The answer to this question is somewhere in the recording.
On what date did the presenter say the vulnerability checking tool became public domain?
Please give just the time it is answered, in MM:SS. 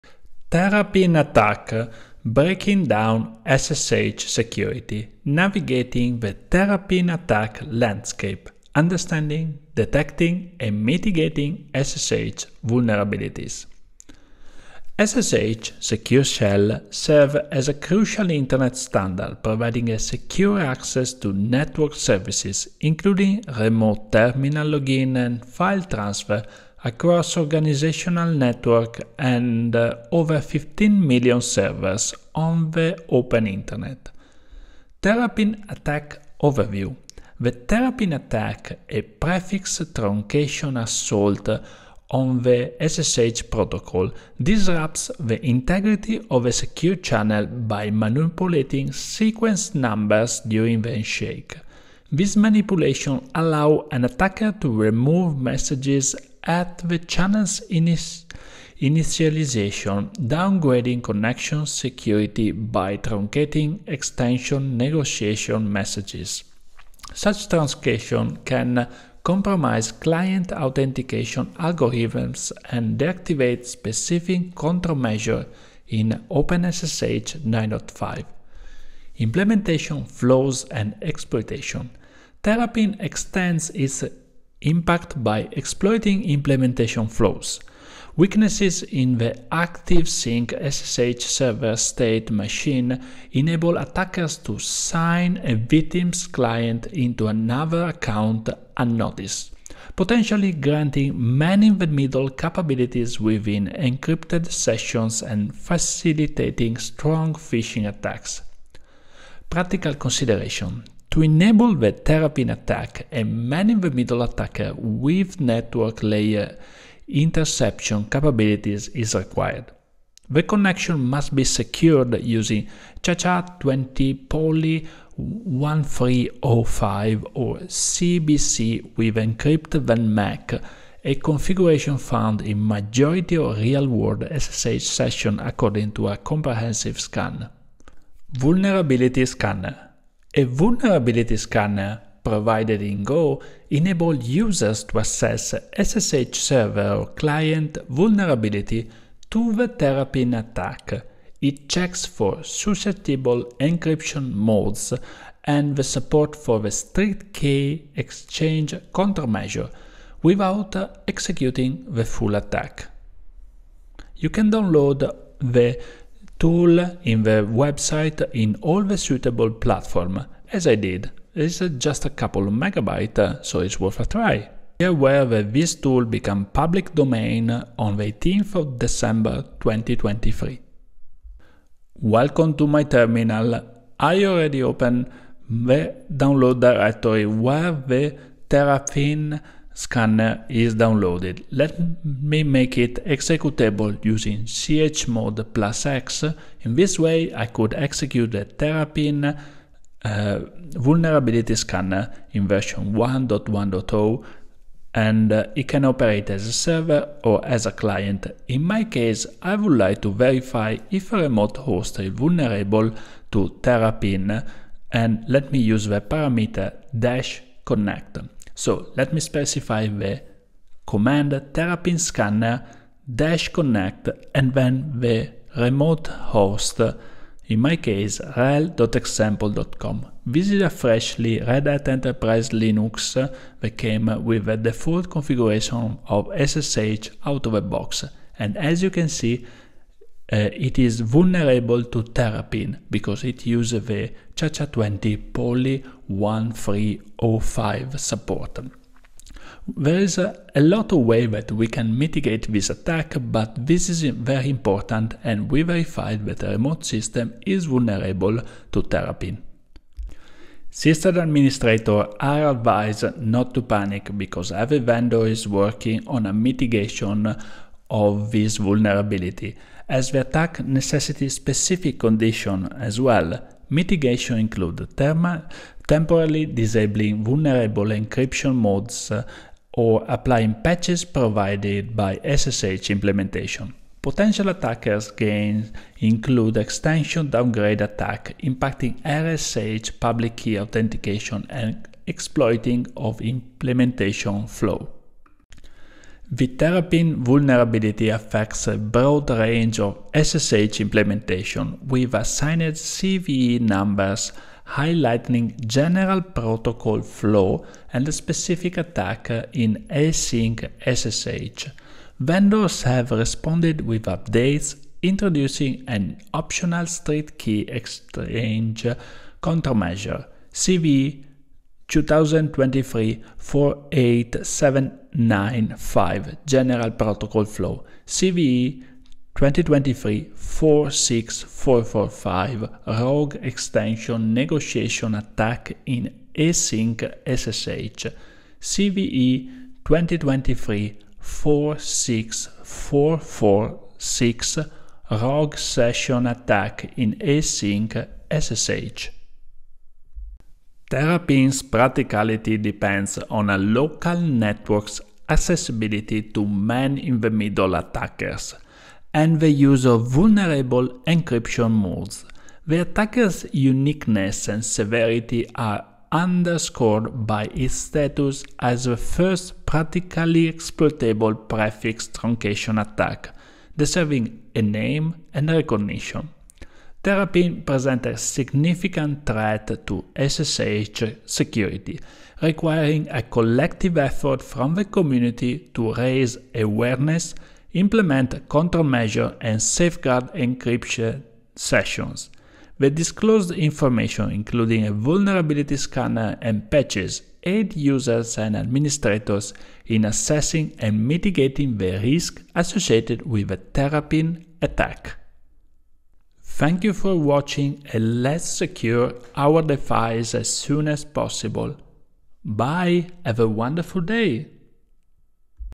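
02:58.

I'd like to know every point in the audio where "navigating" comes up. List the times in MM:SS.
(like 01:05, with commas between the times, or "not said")
00:05.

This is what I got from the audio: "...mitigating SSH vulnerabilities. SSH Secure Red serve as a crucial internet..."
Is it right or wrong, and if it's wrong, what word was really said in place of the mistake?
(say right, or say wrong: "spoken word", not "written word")
wrong: "Shell", not "Red".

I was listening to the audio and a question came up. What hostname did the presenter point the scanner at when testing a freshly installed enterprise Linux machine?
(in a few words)
rhel.example.com.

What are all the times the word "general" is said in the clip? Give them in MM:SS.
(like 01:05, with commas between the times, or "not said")
05:05, 05:26.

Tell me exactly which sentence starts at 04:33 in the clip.
Mitigation include thermal, temporarily disabling vulnerable encryption modes uh, or applying patches provided by SSH implementation.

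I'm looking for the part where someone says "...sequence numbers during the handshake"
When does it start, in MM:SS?
00:48.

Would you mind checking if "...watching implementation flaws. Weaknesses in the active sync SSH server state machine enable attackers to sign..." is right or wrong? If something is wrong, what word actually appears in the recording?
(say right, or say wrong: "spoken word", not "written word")
wrong: "exploiting", not "watching".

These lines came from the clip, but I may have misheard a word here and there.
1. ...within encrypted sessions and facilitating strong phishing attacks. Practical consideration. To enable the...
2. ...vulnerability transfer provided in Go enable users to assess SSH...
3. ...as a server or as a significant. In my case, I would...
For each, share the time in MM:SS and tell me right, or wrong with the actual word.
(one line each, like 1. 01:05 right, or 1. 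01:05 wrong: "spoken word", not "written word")
1. 01:43 right
2. 02:20 wrong: "scanner", not "transfer"
3. 03:26 wrong: "client", not "significant".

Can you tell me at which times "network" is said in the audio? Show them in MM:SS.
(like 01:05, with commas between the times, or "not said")
00:21, 00:28, 01:55, 05:54.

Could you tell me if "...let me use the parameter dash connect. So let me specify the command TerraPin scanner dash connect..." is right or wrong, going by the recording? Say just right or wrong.
right.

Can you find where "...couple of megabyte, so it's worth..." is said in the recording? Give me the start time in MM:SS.
02:52.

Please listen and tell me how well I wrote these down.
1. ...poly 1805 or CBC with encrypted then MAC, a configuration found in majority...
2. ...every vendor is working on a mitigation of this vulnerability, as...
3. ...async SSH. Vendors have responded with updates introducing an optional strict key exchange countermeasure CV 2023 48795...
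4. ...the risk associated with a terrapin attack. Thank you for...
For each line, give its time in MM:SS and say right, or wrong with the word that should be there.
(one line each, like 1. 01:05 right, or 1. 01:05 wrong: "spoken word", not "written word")
1. 02:04 wrong: "1305", not "1805"
2. 04:24 right
3. 05:09 right
4. 06:41 right.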